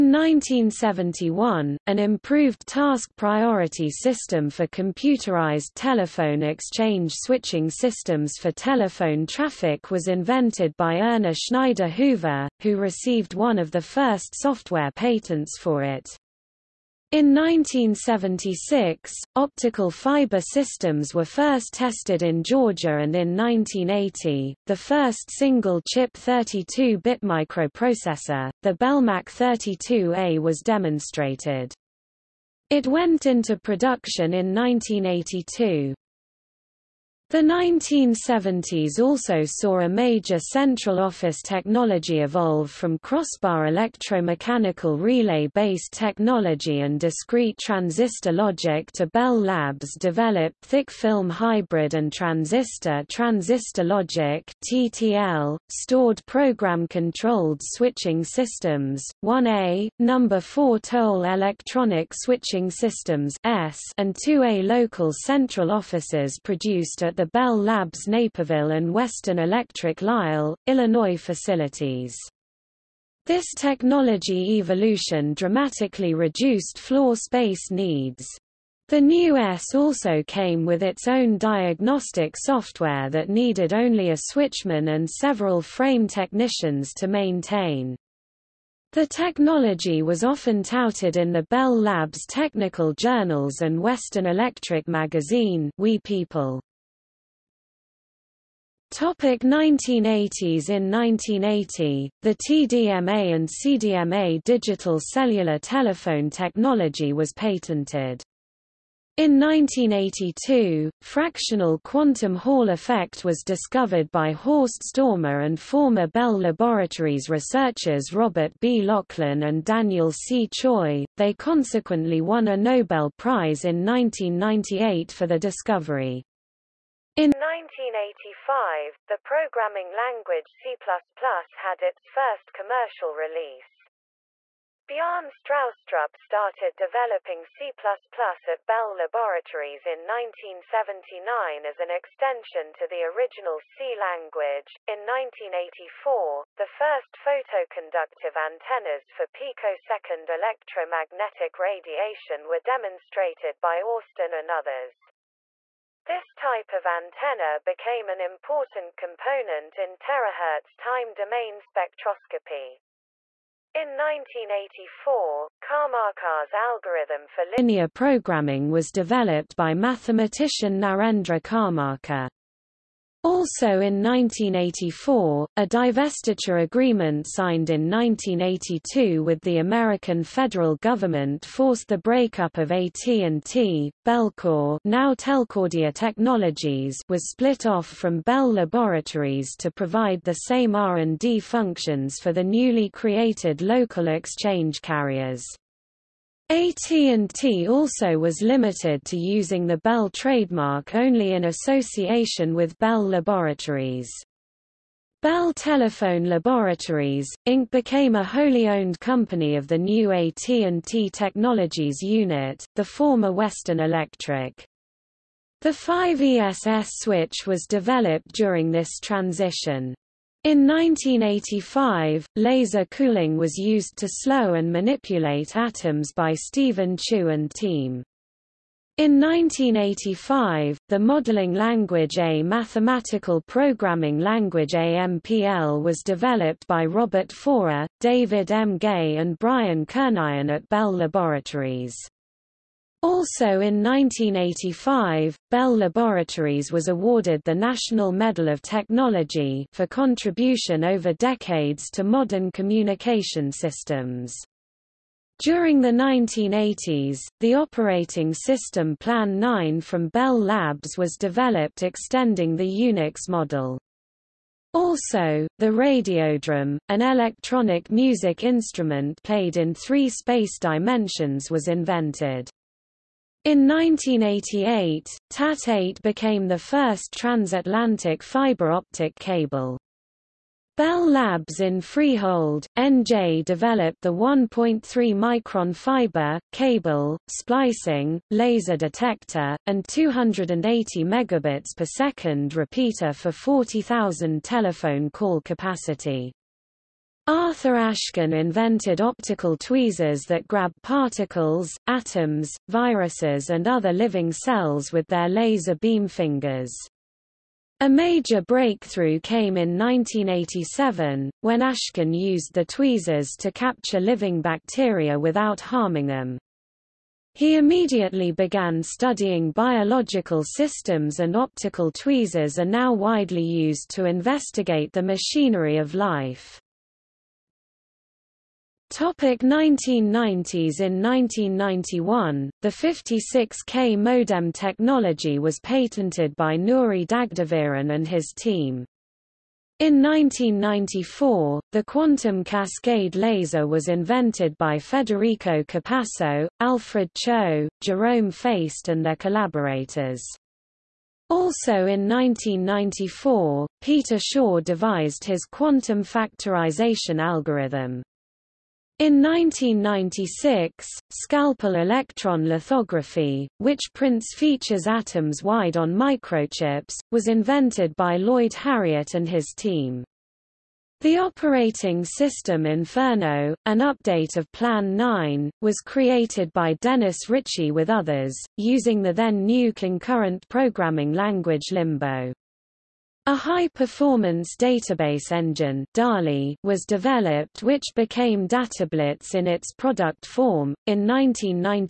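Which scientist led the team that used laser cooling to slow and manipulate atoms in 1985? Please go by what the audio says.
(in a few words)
Stephen Chu.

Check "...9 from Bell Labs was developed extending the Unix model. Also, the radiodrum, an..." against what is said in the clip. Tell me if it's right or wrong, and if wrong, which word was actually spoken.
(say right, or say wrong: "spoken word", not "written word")
right.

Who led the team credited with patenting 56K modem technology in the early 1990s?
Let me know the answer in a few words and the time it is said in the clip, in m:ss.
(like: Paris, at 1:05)
Nuri Dagdeviren, at 5:36.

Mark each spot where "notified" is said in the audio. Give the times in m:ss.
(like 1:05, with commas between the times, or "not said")
not said.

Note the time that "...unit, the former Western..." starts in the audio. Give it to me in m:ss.
3:31.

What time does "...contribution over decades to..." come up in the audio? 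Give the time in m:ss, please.
4:09.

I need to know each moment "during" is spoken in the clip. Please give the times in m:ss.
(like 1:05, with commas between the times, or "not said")
3:38, 4:15.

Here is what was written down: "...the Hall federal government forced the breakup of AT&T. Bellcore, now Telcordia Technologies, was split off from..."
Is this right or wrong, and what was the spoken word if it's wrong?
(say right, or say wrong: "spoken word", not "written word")
wrong: "American", not "Hall".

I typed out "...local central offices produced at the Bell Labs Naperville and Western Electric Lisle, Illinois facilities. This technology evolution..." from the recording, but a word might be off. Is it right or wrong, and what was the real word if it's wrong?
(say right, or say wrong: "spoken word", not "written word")
right.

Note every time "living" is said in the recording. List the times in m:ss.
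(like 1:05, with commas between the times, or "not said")
5:03, 5:13.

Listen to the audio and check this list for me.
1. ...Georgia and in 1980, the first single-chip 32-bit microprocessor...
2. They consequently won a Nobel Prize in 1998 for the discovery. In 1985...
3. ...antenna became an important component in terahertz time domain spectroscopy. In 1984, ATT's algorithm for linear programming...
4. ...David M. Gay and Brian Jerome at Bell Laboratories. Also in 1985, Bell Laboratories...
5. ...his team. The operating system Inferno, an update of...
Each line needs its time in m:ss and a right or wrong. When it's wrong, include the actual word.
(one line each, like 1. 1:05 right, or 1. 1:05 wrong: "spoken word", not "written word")
1. 0:22 right
2. 2:01 right
3. 2:36 wrong: "Karmarkar", not "ATT"
4. 3:57 wrong: "Kernighan", not "Jerome"
5. 6:09 right.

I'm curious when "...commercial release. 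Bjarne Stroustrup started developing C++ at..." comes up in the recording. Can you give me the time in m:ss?
2:12.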